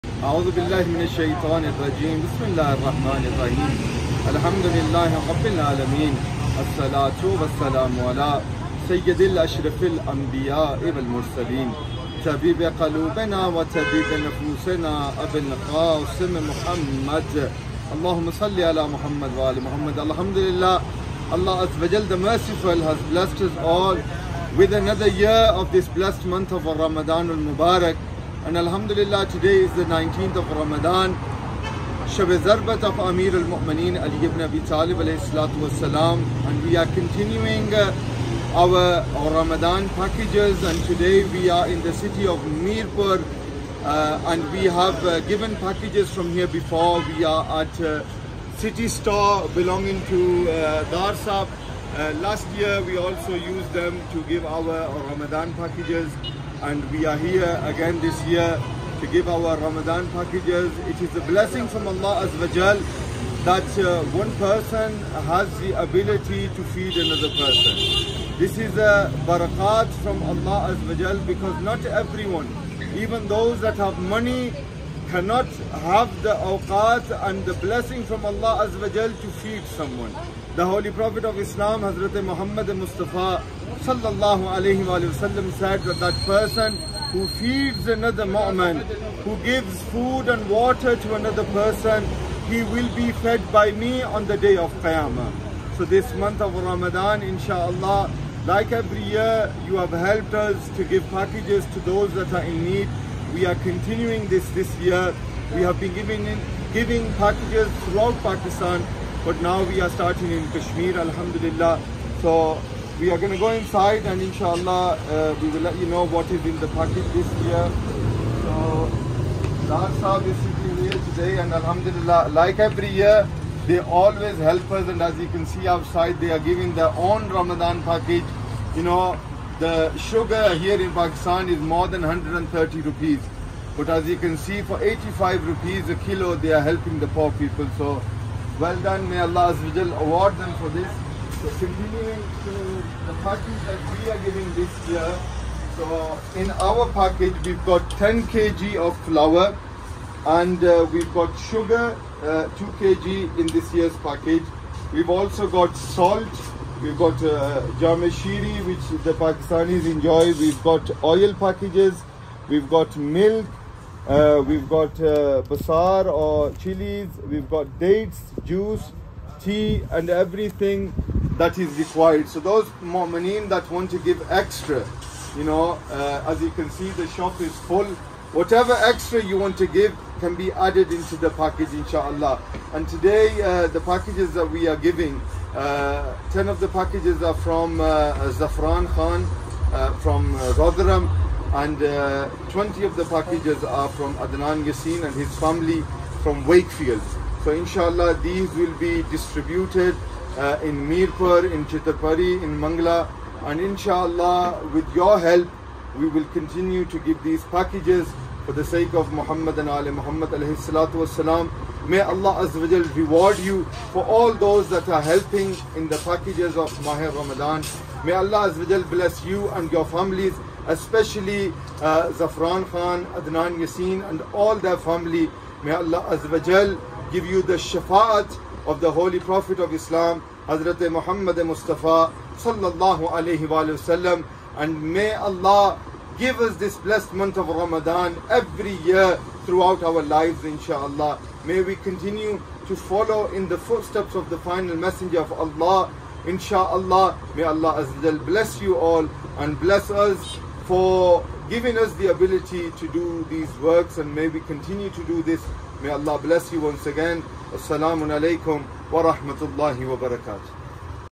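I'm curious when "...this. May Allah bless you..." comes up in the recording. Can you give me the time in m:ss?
4:15.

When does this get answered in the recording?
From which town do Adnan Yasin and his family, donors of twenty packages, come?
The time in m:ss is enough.
3:16.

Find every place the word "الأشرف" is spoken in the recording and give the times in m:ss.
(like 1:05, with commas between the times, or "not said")
0:09.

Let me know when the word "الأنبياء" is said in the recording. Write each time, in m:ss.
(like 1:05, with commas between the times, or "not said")
0:09.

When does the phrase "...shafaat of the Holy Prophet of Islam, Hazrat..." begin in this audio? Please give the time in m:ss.
3:47.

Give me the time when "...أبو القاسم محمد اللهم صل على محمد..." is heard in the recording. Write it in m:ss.
0:15.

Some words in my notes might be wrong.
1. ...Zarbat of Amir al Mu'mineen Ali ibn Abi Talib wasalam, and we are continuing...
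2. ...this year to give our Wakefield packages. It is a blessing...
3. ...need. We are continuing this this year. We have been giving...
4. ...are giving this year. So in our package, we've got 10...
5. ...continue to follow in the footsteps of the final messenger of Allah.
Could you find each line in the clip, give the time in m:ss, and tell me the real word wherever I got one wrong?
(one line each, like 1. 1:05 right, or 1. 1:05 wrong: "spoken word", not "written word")
1. 0:32 right
2. 0:58 wrong: "Ramadan", not "Wakefield"
3. 1:42 right
4. 2:24 right
5. 4:01 right.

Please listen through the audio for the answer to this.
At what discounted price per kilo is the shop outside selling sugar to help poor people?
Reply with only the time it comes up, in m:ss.
2:14.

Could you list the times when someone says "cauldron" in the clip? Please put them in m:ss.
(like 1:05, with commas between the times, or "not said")
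not said.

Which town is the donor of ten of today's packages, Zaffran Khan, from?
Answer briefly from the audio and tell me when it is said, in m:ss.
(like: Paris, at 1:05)
Rotherham, at 3:10.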